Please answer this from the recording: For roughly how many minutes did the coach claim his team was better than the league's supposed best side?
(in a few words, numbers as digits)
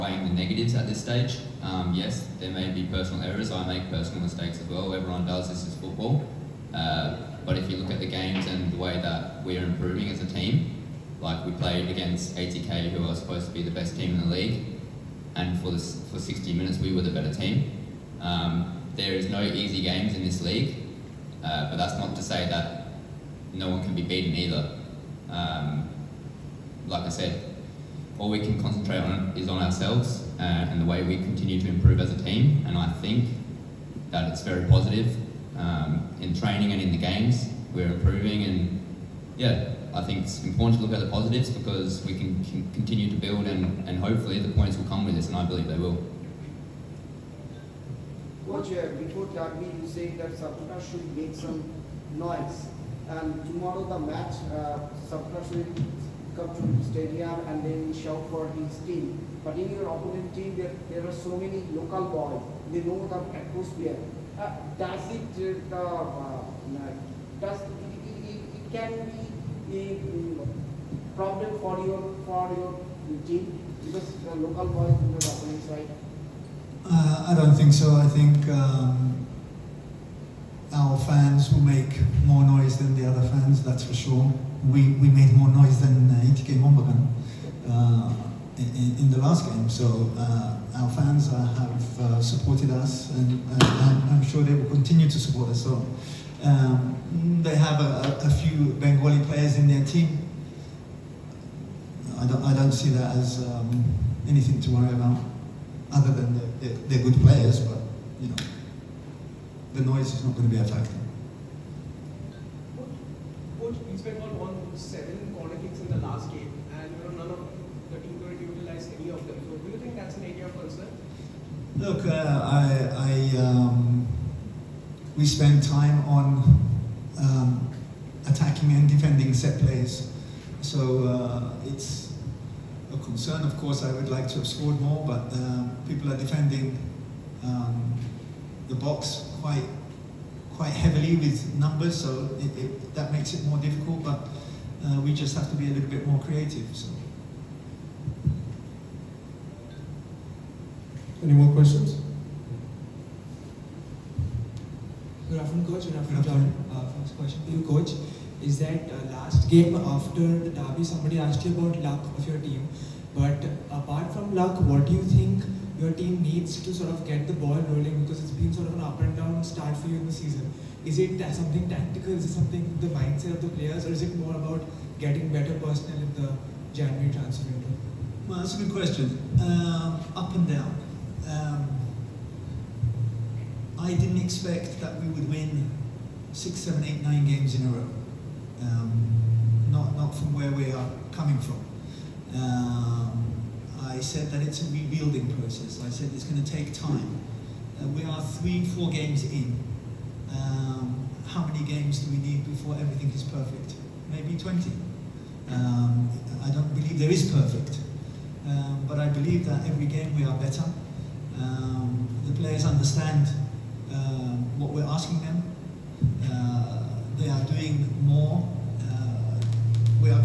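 60.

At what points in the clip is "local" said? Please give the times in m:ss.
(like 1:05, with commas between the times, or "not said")
1:01, 1:14.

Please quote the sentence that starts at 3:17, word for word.
Uh, we are three, four games in.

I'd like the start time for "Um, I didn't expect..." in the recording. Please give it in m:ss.
3:01.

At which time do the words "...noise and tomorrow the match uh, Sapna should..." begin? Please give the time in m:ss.
0:52.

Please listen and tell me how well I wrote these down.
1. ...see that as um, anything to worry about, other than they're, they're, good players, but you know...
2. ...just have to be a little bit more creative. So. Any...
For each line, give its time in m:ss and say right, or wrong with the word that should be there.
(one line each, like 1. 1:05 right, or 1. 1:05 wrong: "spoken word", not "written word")
1. 1:42 right
2. 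2:25 right.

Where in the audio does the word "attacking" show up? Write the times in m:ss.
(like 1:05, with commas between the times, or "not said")
2:08.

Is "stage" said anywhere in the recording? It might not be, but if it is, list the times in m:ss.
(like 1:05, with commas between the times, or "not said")
0:01.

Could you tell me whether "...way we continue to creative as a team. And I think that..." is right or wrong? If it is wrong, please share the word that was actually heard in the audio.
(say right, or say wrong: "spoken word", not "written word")
wrong: "improve", not "creative".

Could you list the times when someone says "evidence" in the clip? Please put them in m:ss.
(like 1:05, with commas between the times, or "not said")
not said.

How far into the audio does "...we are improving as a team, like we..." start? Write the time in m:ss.
0:09.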